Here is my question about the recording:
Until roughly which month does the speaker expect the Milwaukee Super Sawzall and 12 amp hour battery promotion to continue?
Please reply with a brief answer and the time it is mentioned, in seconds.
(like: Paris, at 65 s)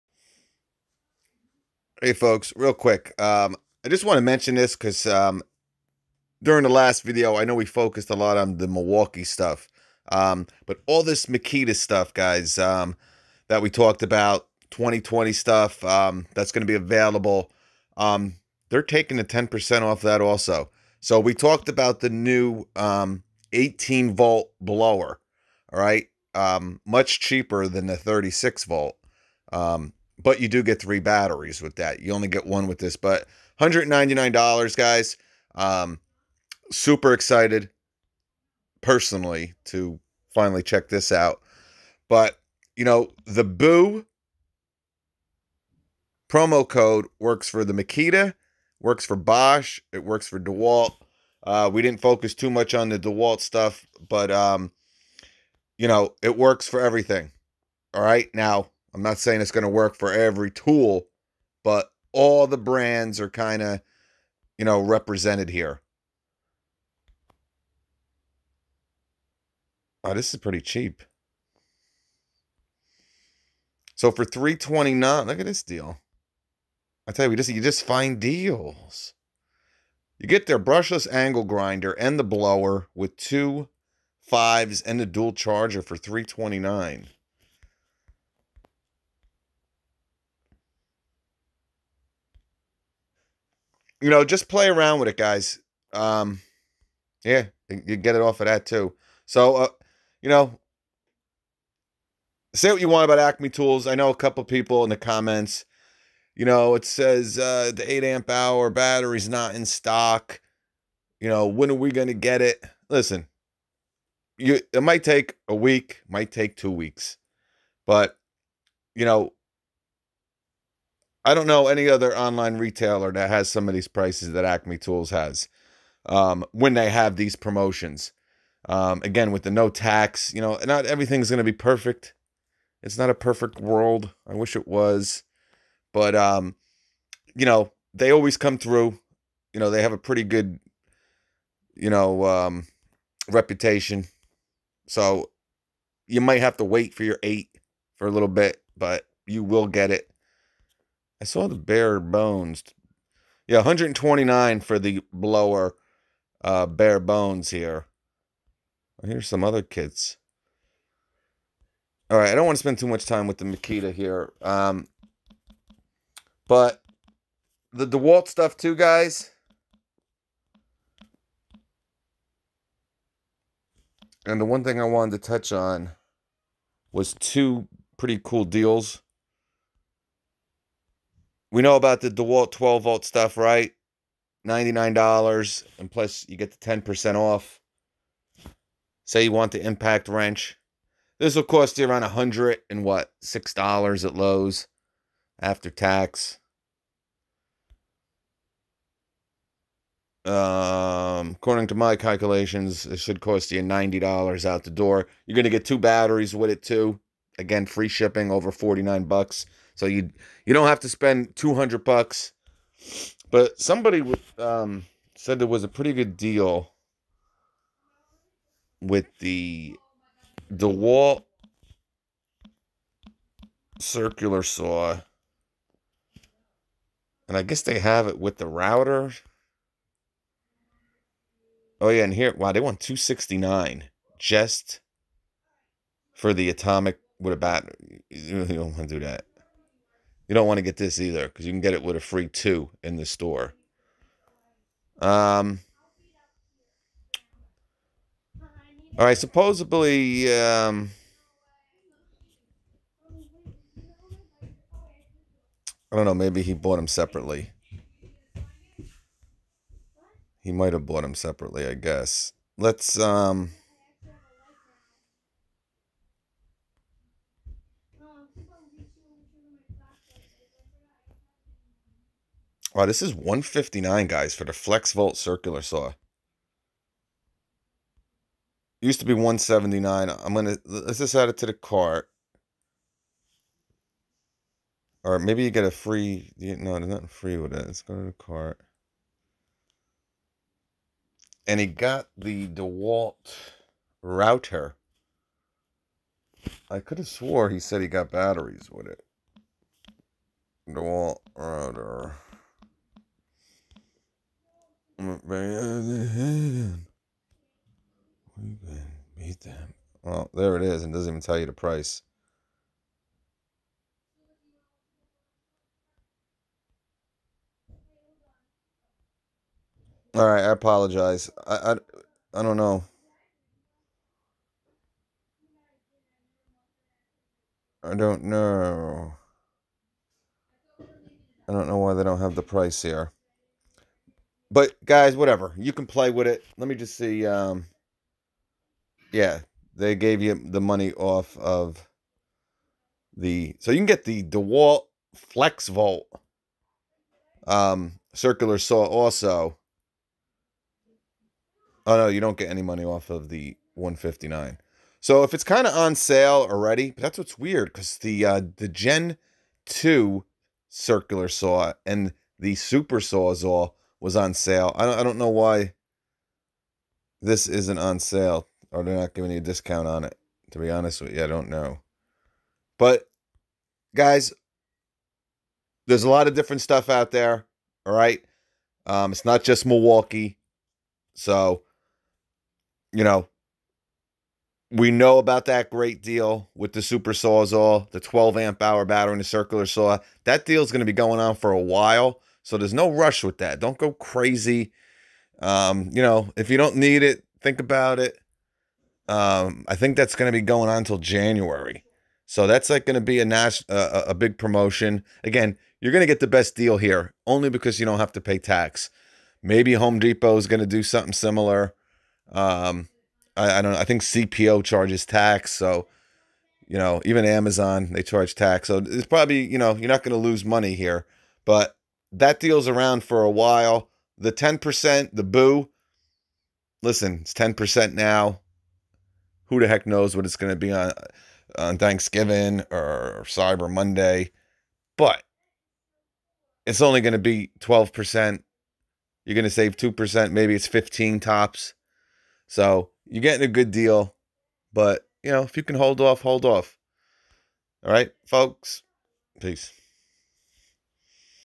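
January, at 400 s.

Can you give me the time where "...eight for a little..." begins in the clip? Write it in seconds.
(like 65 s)
147 s.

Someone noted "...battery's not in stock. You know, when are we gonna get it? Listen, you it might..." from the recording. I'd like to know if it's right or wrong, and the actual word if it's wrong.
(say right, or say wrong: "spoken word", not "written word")
right.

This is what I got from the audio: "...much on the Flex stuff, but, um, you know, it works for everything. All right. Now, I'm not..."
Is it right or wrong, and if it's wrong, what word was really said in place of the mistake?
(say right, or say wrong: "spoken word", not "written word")
wrong: "DeWalt", not "Flex".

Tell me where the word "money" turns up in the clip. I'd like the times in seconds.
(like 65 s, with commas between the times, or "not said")
340 s, 352 s, 420 s.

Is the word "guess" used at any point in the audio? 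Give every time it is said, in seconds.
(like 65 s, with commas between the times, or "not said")
227 s, 261 s.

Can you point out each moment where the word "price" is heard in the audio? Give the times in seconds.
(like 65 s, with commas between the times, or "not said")
123 s, 311 s, 332 s.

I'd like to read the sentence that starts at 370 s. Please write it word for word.
To be honest with you, I don't know.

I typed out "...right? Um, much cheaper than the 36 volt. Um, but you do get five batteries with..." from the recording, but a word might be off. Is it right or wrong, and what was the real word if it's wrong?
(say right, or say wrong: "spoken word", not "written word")
wrong: "three", not "five".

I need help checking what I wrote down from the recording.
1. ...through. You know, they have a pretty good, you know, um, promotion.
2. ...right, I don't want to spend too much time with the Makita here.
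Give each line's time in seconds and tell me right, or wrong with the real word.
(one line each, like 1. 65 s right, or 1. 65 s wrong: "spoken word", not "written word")
1. 138 s wrong: "reputation", not "promotion"
2. 162 s right.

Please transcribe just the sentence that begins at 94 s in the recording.
you know, just play around with it, guys.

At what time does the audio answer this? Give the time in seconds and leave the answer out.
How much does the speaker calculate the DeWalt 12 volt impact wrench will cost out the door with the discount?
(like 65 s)
203 s.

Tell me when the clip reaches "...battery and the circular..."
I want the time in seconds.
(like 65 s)
388 s.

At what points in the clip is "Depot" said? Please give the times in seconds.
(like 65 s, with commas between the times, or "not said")
409 s.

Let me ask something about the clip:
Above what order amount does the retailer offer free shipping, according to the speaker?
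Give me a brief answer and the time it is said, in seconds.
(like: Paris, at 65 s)
$49, at 208 s.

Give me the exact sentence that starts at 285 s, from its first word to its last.
Or maybe you get a free no, there's nothing free with it.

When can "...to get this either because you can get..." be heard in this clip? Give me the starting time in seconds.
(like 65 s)
240 s.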